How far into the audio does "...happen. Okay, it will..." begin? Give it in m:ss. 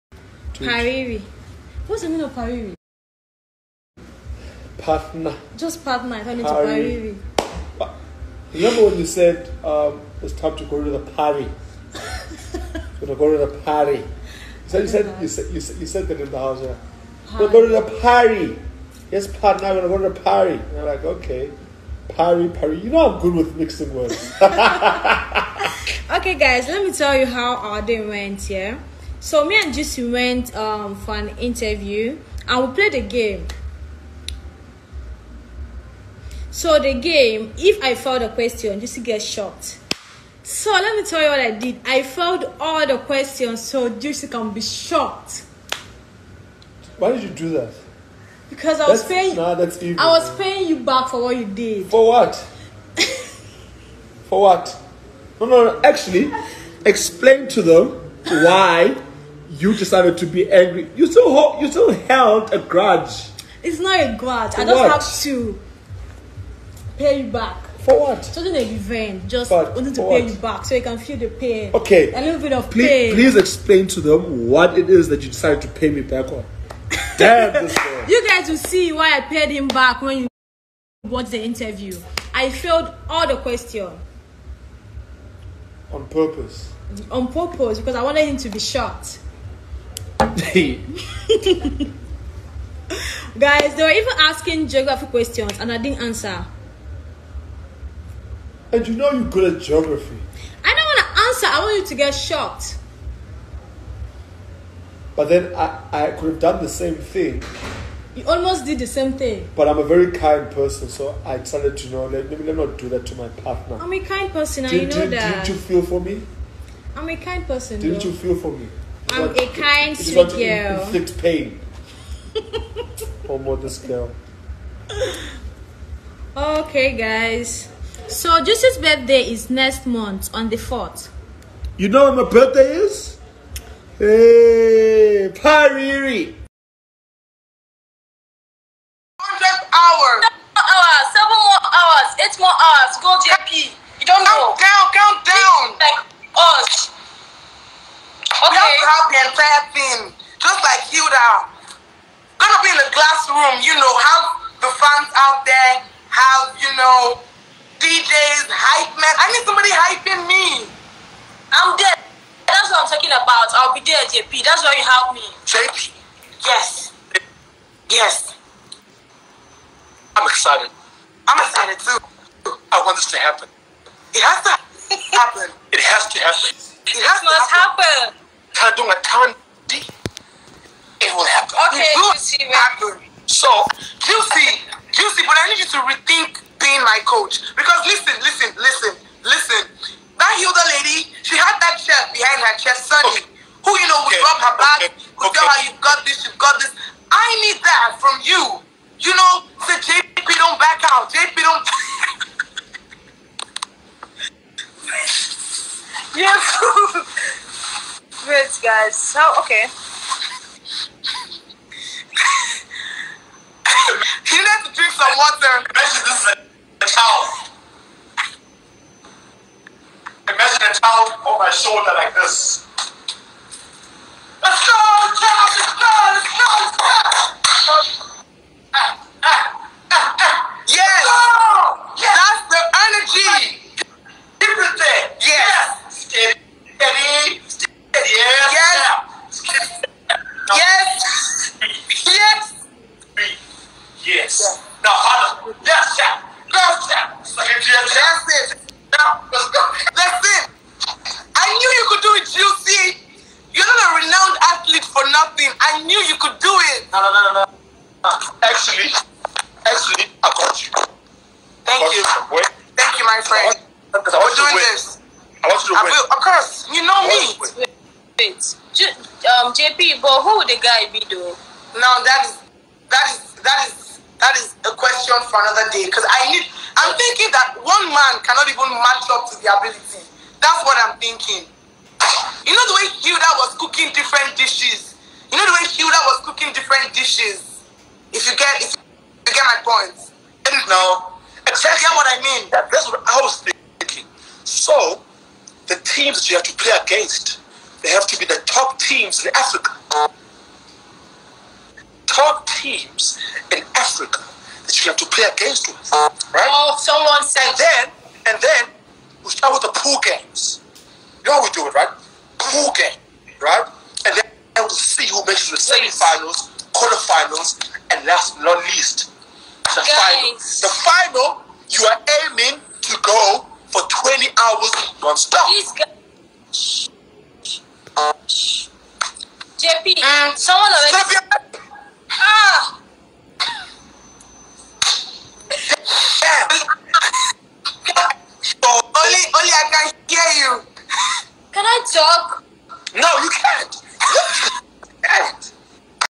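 3:01.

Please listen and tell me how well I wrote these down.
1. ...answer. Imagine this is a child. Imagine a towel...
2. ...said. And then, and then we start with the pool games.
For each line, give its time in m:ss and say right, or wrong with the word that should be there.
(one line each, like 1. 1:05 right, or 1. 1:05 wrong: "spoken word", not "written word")
1. 3:35 wrong: "water", not "answer"
2. 5:07 right.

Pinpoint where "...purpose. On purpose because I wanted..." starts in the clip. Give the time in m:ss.
1:26.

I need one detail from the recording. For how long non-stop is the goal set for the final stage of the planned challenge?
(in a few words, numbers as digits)
20 hours.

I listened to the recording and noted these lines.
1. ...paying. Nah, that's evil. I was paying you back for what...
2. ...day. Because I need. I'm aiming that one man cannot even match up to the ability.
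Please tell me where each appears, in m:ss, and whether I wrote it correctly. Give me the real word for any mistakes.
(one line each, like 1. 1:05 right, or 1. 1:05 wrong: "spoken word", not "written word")
1. 0:49 right
2. 4:35 wrong: "thinking", not "aiming".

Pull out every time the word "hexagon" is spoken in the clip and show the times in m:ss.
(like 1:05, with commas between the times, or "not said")
not said.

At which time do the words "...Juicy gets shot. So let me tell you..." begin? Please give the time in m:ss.
0:38.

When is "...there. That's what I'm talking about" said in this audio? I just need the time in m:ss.
2:41.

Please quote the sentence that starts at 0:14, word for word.
So you said, you said, you said you said that in the house.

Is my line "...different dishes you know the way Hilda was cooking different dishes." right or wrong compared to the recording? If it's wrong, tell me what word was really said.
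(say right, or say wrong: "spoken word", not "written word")
right.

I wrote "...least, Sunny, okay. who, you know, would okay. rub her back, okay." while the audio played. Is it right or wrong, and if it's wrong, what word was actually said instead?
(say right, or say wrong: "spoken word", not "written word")
wrong: "chest", not "least".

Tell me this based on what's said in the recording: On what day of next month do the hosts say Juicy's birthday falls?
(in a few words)
The fourth.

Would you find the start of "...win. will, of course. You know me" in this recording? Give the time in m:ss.
4:25.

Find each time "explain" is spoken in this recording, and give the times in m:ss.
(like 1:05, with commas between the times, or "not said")
0:56, 1:13.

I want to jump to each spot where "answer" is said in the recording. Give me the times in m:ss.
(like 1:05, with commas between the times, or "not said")
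1:36, 1:41.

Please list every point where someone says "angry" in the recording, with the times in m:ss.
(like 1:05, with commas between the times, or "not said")
1:00.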